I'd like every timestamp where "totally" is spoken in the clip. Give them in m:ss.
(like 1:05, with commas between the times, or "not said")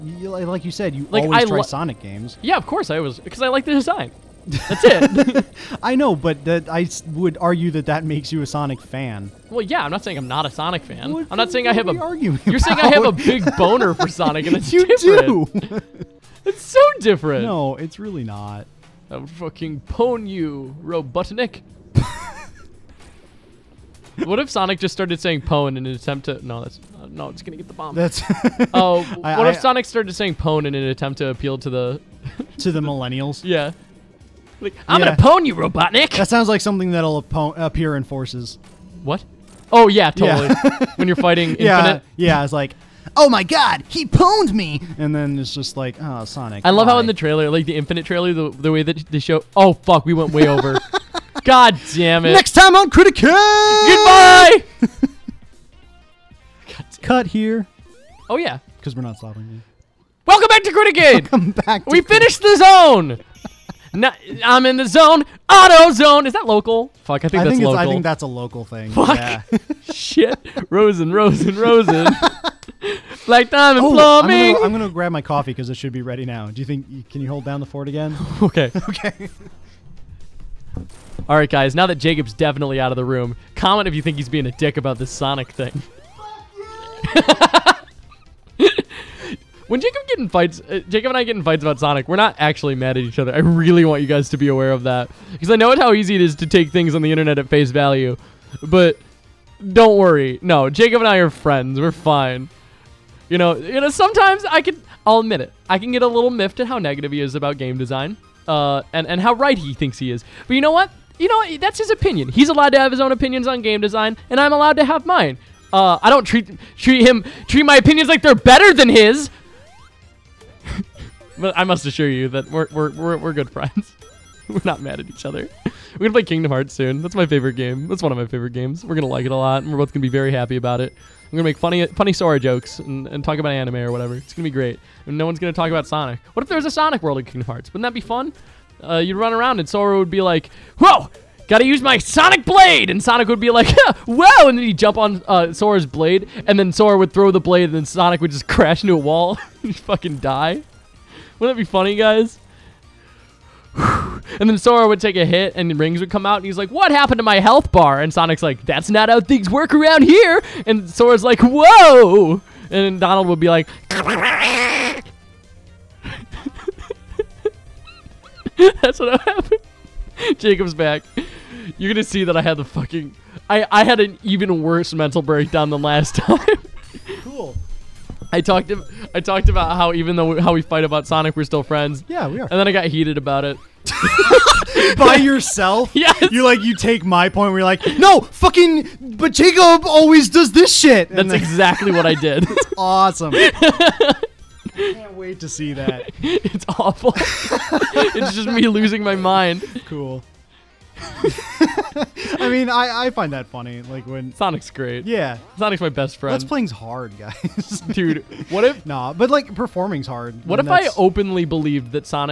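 0:40.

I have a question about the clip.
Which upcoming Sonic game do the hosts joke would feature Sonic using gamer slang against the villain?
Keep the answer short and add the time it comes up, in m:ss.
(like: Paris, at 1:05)
Forces, at 0:38.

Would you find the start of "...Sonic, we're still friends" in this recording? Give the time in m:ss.
3:01.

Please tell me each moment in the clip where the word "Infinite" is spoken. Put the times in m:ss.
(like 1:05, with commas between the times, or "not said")
0:41, 0:47.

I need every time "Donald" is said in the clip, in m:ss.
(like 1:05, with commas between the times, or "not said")
2:43.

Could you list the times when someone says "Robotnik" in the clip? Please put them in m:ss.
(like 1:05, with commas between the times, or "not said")
0:20, 0:35.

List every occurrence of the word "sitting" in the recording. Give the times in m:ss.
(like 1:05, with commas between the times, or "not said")
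not said.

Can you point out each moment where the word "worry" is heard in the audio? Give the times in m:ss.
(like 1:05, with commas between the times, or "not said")
1:39.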